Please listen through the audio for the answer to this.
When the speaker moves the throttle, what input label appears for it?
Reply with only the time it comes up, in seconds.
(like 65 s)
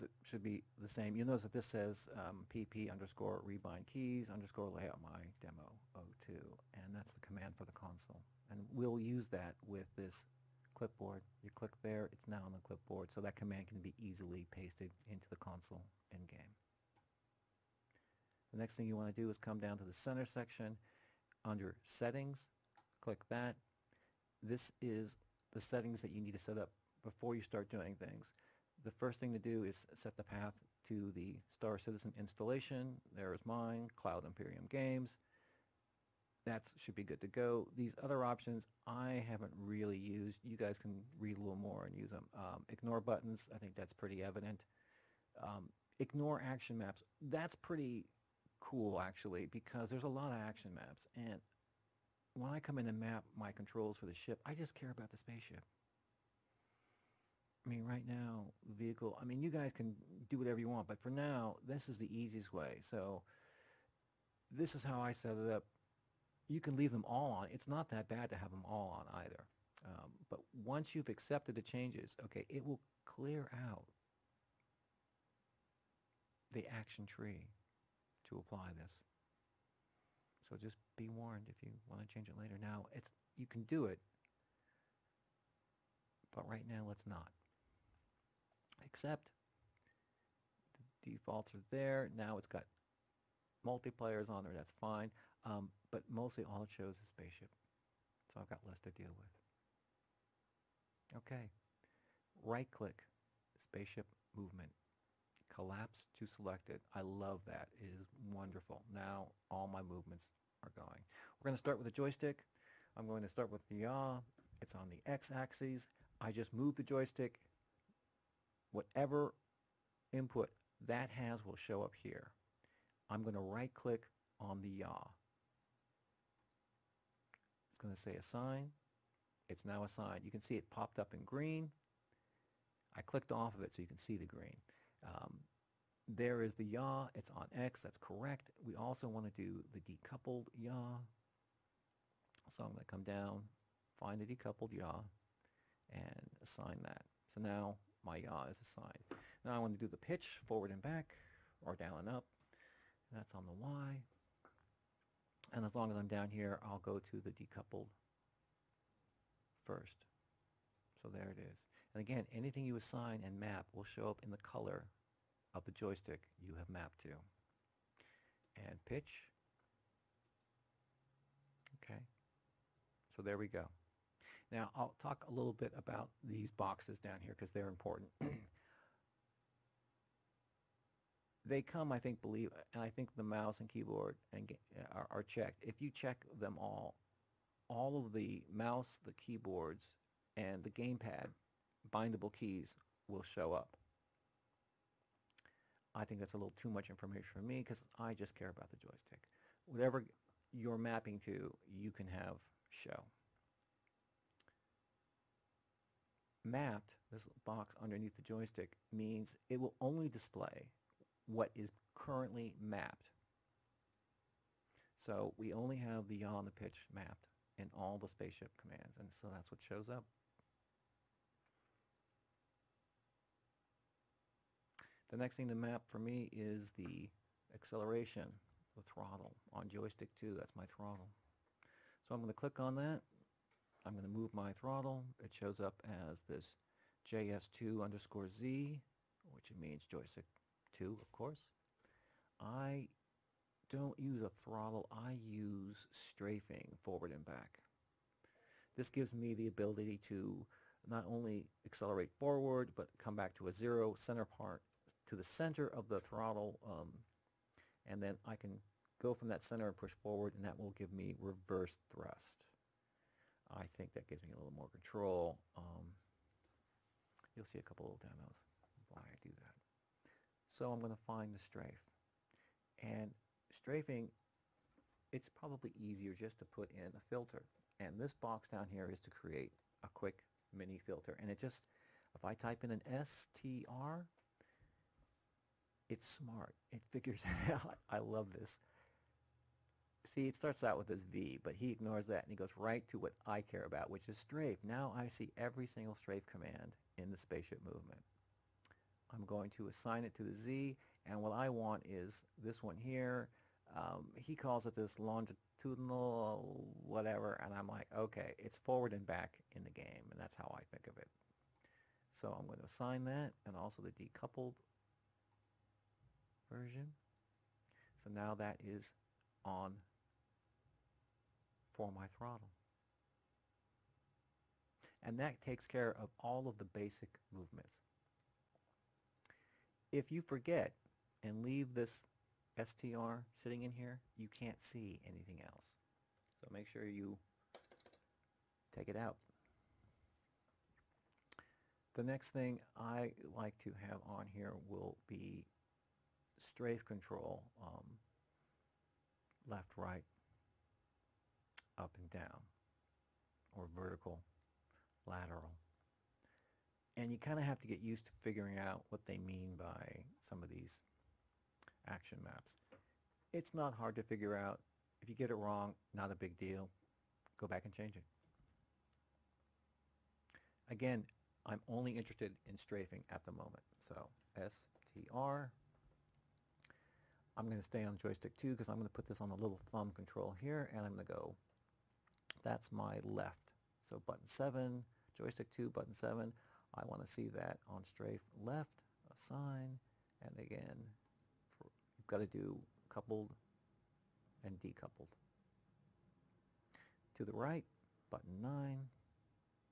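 237 s.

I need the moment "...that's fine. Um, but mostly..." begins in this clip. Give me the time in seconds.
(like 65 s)
94 s.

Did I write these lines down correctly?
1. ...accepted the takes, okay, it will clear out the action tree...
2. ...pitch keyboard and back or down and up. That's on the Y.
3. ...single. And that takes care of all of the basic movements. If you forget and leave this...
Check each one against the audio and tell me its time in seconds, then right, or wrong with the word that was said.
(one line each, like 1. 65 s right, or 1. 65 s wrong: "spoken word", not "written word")
1. 71 s wrong: "changes", not "takes"
2. 149 s wrong: "forward", not "keyboard"
3. 322 s wrong: "throttle", not "single".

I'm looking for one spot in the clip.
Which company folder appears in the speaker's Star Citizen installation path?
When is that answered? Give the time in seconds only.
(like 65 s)
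33 s.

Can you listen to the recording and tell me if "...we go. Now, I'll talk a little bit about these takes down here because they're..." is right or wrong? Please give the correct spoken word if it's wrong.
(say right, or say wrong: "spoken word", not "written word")
wrong: "boxes", not "takes".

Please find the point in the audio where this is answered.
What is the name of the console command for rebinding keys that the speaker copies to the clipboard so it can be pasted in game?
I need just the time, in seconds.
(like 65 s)
2 s.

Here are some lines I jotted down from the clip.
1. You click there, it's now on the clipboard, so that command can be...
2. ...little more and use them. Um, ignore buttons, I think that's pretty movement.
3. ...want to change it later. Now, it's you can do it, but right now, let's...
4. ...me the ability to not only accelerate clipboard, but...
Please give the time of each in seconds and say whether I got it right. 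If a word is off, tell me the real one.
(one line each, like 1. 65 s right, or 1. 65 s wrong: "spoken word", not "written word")
1. 11 s right
2. 41 s wrong: "evident", not "movement"
3. 81 s right
4. 249 s wrong: "forward", not "clipboard".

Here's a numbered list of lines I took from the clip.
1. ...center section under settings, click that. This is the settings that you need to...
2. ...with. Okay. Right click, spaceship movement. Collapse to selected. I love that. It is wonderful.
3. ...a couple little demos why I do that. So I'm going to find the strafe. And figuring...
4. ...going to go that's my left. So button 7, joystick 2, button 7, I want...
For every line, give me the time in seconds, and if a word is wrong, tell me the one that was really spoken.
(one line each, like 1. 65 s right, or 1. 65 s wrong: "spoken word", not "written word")
1. 19 s right
2. 99 s right
3. 267 s wrong: "strafing", not "figuring"
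4. 380 s right.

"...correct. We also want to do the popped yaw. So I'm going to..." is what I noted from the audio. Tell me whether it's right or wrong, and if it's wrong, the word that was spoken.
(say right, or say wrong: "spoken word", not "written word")
wrong: "decoupled", not "popped".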